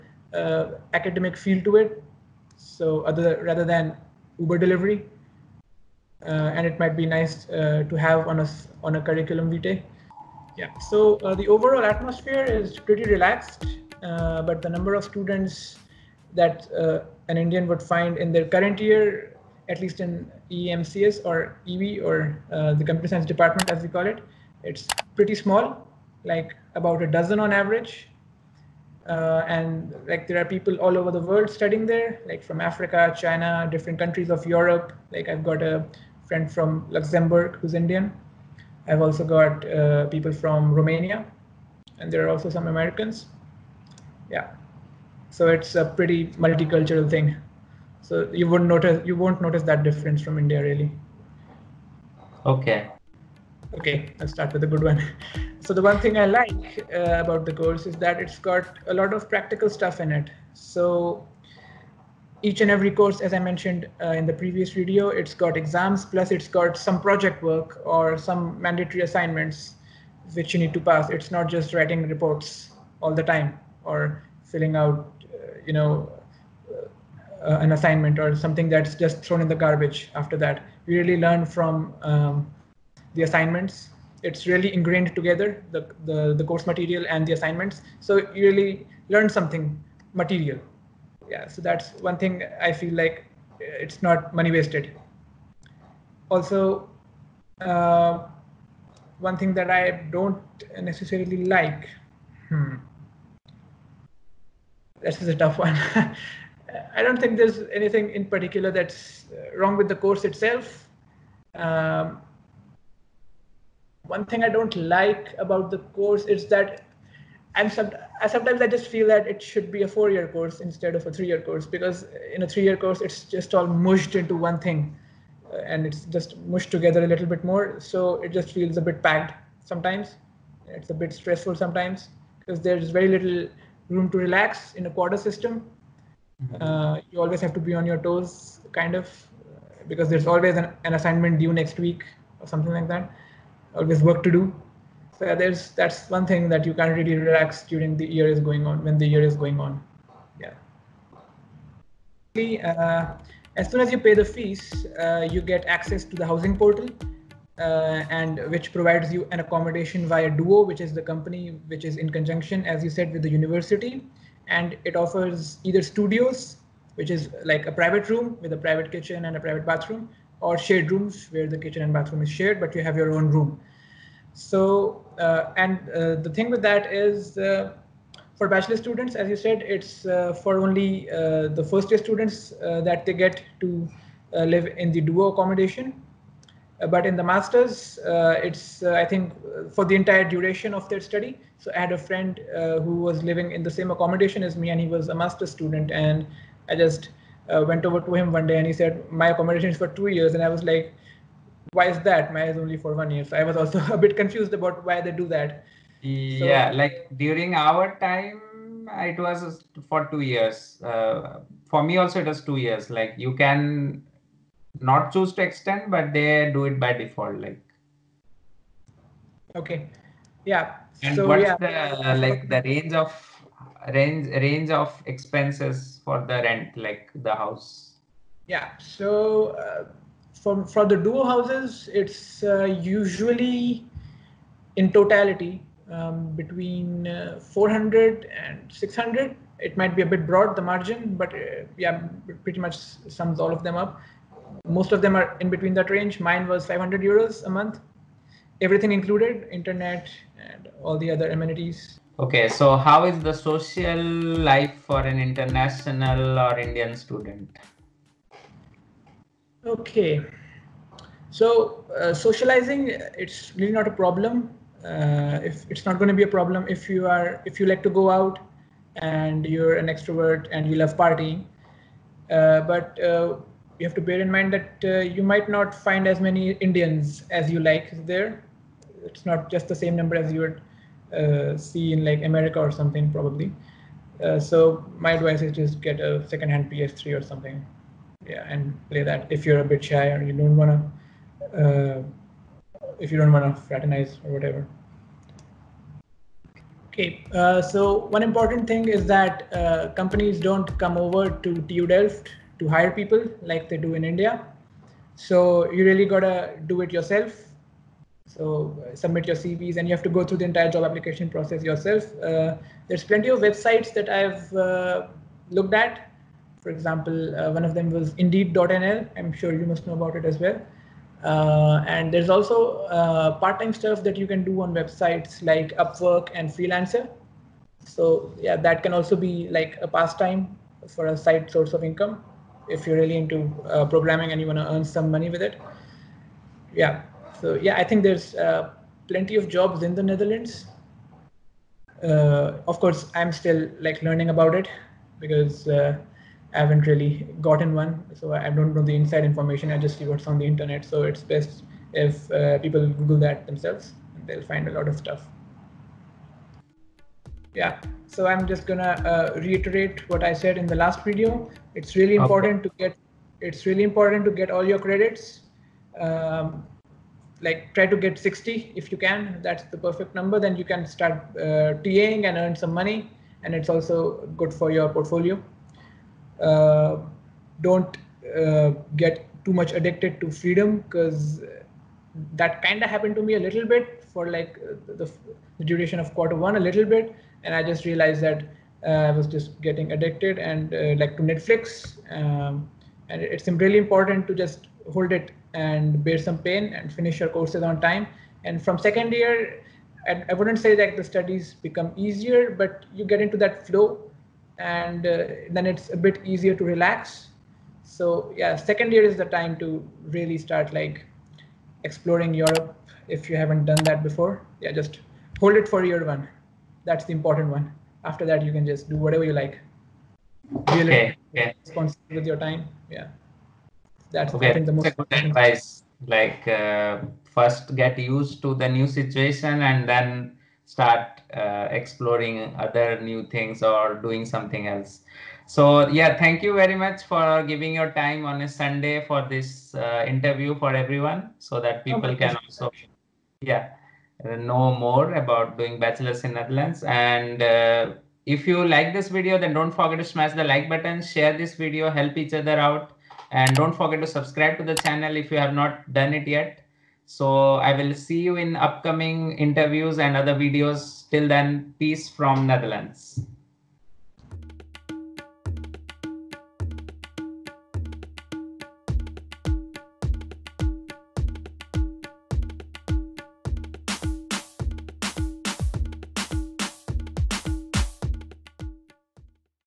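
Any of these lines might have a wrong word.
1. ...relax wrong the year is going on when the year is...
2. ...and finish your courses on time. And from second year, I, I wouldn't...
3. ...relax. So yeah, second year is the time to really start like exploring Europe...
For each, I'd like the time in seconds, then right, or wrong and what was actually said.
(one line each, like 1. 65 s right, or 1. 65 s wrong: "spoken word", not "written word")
1. 147 s wrong: "during", not "wrong"
2. 396 s right
3. 406 s right.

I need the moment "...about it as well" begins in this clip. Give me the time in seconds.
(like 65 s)
319 s.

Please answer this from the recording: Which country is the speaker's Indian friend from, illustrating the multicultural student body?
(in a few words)
Luxembourg.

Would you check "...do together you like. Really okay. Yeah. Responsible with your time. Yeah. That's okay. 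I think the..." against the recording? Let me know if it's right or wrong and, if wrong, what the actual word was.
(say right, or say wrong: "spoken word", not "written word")
wrong: "whatever", not "together".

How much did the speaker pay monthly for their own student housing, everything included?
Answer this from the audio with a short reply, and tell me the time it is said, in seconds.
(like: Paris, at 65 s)
500 euros, at 246 s.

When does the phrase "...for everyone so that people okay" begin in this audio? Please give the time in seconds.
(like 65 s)
440 s.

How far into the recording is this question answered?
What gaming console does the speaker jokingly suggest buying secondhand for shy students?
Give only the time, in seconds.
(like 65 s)
286 s.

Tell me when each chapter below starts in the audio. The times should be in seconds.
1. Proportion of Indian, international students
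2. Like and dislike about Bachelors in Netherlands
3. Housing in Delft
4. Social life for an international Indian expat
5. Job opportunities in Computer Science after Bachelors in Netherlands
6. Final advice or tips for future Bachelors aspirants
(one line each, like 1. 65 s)
1. 9 s
2. 52 s
3. 151 s
4. 251 s
5. 295 s
6. 355 s.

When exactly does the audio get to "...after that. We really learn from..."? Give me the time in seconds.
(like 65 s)
80 s.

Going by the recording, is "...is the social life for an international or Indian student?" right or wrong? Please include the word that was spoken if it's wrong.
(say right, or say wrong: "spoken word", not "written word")
right.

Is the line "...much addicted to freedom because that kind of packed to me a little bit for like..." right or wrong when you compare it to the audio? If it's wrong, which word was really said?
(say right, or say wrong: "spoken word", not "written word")
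wrong: "happened", not "packed".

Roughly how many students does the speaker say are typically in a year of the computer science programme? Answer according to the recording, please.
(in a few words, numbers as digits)
about a dozen.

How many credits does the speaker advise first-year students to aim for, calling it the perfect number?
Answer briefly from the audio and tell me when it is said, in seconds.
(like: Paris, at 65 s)
60, at 368 s.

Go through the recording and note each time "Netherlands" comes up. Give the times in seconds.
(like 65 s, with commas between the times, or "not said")
340 s, 446 s, 462 s.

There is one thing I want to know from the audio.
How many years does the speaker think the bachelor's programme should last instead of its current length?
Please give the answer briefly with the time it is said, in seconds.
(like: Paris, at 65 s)
4, at 119 s.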